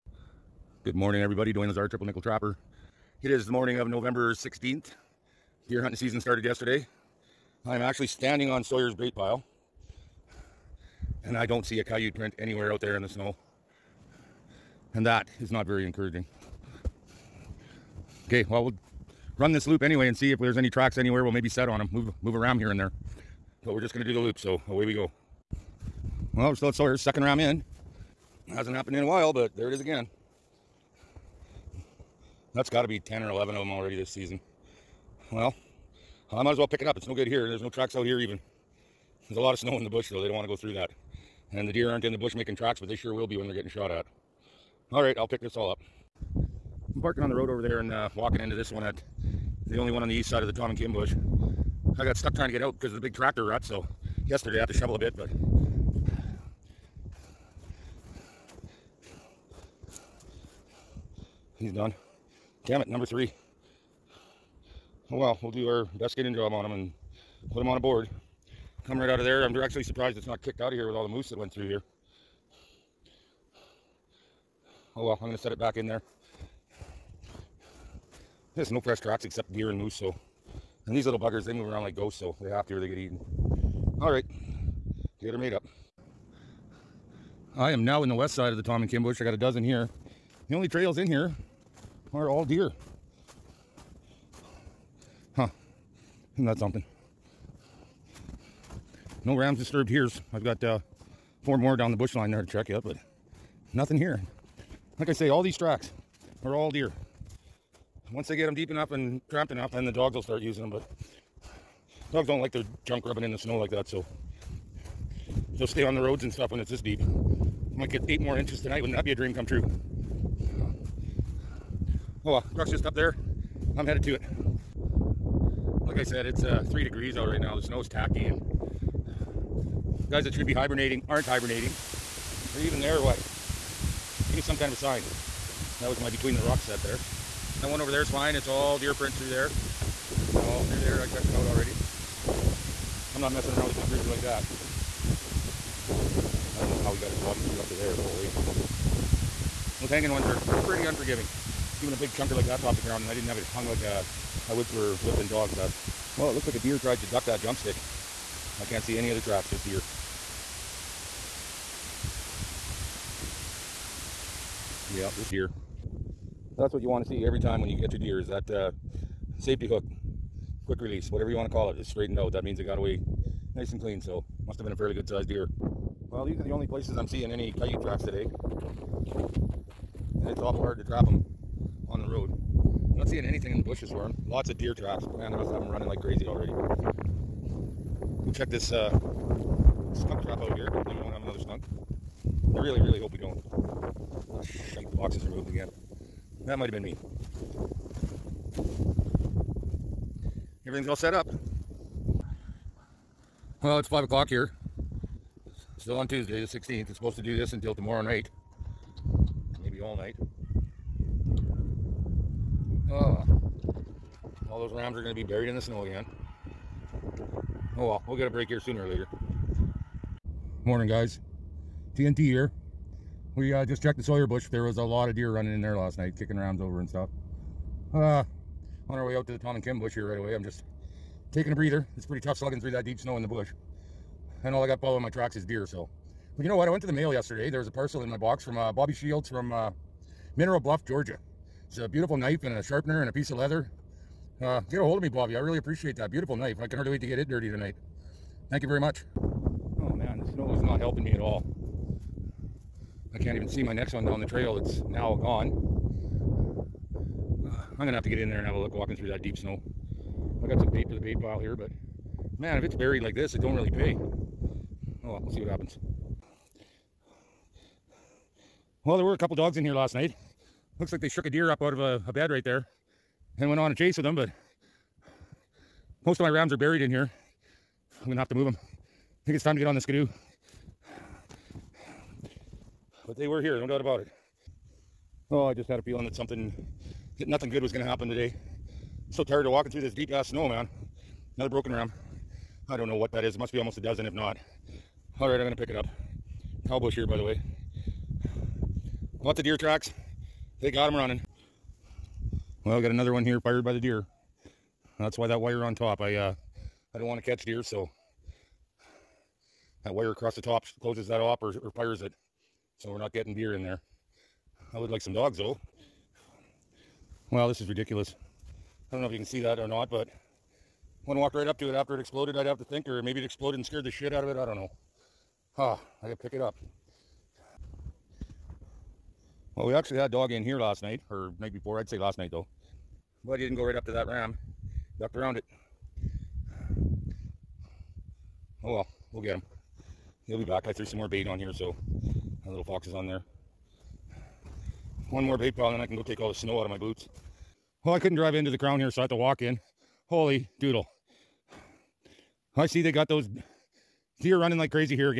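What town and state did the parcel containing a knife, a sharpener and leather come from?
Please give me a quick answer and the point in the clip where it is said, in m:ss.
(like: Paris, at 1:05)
Mineral Bluff, Georgia, at 4:00.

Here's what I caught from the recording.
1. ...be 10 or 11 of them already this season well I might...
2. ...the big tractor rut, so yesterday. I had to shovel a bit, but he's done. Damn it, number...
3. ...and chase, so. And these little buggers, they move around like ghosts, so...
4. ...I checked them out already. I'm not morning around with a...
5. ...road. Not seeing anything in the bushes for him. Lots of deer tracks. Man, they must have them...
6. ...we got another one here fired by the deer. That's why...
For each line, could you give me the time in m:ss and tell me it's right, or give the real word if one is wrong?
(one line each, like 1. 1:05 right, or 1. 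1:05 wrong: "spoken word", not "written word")
1. 0:32 right
2. 0:52 right
3. 1:19 wrong: "moose", not "chase"
4. 2:21 wrong: "messing", not "morning"
5. 3:02 right
6. 5:02 right.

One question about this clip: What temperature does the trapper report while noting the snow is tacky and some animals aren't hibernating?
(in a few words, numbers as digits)
3 degrees.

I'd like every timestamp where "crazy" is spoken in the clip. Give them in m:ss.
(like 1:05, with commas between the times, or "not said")
3:06, 5:54.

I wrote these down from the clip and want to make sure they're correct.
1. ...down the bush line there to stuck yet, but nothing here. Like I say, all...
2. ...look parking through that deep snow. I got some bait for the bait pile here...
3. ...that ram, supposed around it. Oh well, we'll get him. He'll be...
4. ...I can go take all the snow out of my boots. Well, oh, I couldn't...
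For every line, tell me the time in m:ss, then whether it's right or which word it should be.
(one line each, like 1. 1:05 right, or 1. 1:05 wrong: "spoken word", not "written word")
1. 1:41 wrong: "check", not "stuck"
2. 4:18 wrong: "walking", not "parking"
3. 5:33 wrong: "ducked", not "supposed"
4. 5:45 right.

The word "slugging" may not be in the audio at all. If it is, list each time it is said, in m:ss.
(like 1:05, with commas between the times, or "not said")
3:52.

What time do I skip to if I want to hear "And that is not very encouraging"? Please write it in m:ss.
0:14.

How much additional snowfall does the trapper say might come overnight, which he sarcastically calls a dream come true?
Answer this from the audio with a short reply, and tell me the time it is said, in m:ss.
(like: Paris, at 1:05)
8 inches, at 1:58.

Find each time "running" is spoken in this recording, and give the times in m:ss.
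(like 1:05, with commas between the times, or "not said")
3:05, 3:45, 5:00, 5:54.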